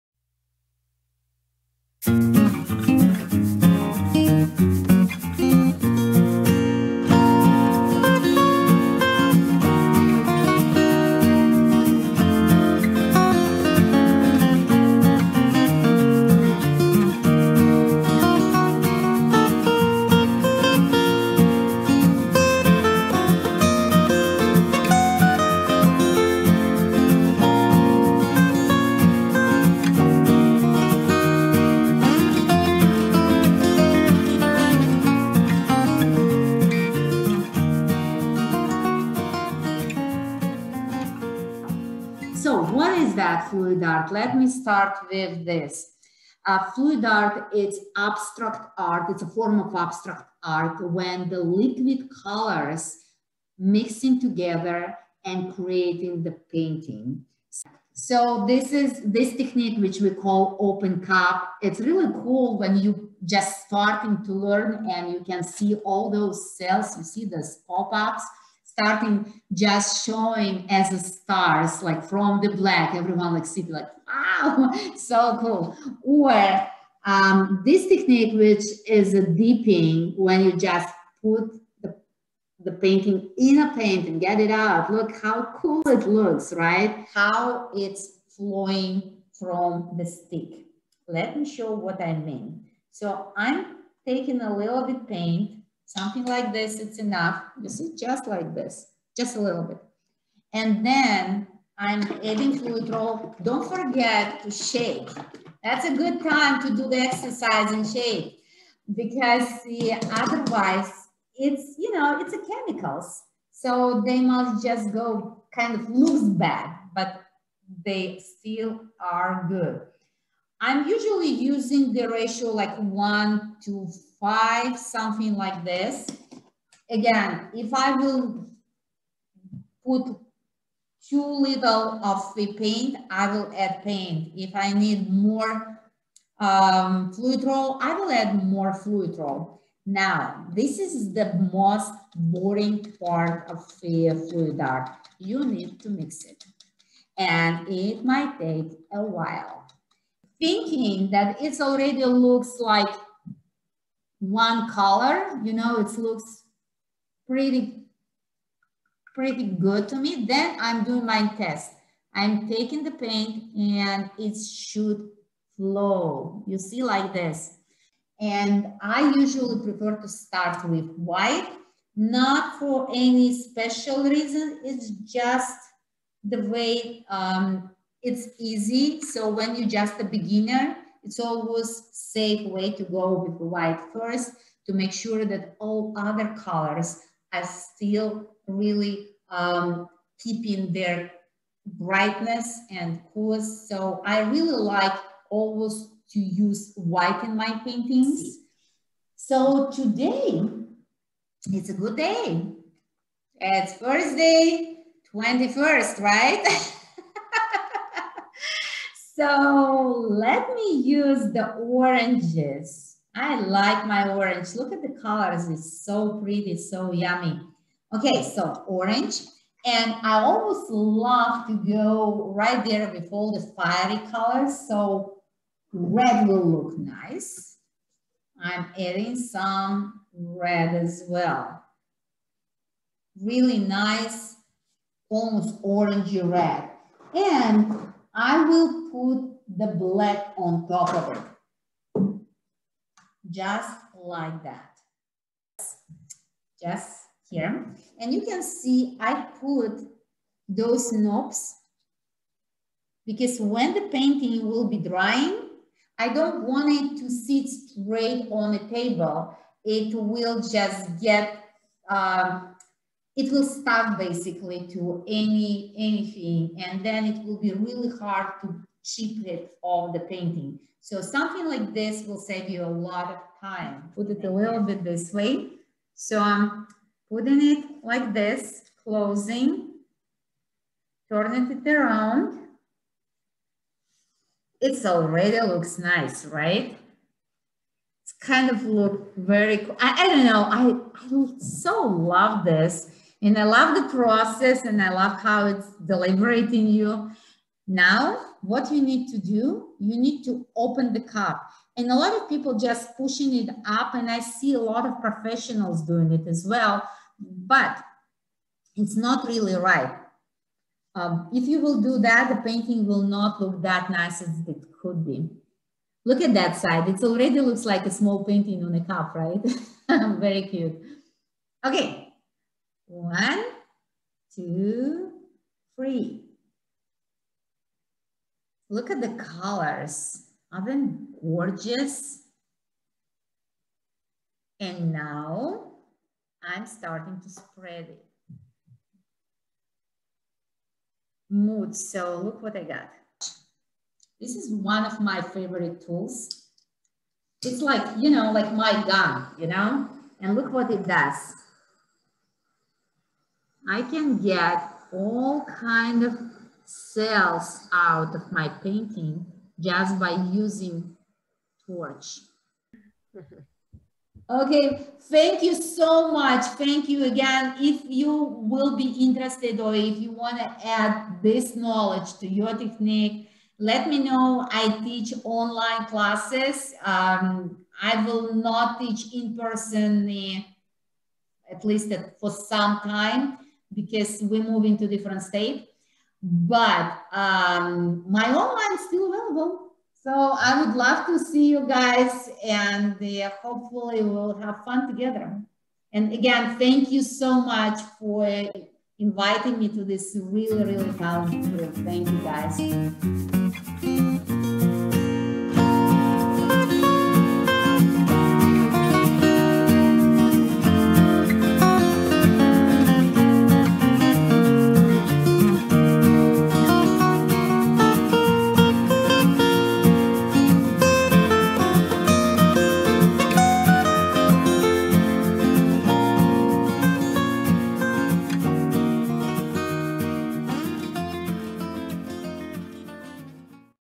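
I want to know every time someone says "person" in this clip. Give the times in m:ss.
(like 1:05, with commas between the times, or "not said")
6:19.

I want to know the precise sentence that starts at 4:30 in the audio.
So something like this will save you a lot of time.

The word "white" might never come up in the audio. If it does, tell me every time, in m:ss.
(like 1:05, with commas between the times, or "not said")
2:50, 3:03, 3:16.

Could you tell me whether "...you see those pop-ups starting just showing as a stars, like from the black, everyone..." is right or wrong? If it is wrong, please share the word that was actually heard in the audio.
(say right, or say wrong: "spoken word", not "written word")
right.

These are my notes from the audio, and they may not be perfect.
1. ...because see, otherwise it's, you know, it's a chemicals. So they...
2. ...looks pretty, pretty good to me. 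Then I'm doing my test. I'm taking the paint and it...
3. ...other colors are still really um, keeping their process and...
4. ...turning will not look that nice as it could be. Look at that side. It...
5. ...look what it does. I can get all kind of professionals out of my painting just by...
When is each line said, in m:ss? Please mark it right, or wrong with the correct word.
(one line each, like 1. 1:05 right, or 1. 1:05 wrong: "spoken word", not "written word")
1. 1:48 right
2. 2:35 right
3. 3:05 wrong: "brightness", not "process"
4. 5:12 wrong: "painting", not "turning"
5. 5:50 wrong: "cells", not "professionals".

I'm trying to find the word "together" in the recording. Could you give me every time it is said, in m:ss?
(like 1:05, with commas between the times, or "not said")
0:54, 6:34.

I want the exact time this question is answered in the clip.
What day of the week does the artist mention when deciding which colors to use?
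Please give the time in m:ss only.
3:23.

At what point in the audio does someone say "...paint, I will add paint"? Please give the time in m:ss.
2:12.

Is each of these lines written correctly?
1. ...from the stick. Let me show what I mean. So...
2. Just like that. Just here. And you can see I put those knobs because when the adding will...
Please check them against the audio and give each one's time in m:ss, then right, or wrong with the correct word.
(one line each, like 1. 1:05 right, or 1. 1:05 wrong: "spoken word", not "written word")
1. 1:29 right
2. 4:03 wrong: "painting", not "adding".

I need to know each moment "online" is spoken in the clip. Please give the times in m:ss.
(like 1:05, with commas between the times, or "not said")
6:15, 6:28.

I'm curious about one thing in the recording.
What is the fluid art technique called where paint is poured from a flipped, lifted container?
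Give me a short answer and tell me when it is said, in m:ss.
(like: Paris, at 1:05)
open cup, at 1:00.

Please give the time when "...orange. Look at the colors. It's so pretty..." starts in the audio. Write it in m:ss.
3:34.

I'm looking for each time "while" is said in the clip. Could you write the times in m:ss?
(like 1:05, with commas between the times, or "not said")
2:29.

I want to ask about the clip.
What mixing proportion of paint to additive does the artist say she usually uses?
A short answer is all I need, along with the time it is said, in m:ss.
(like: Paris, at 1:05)
1 to 5, at 2:02.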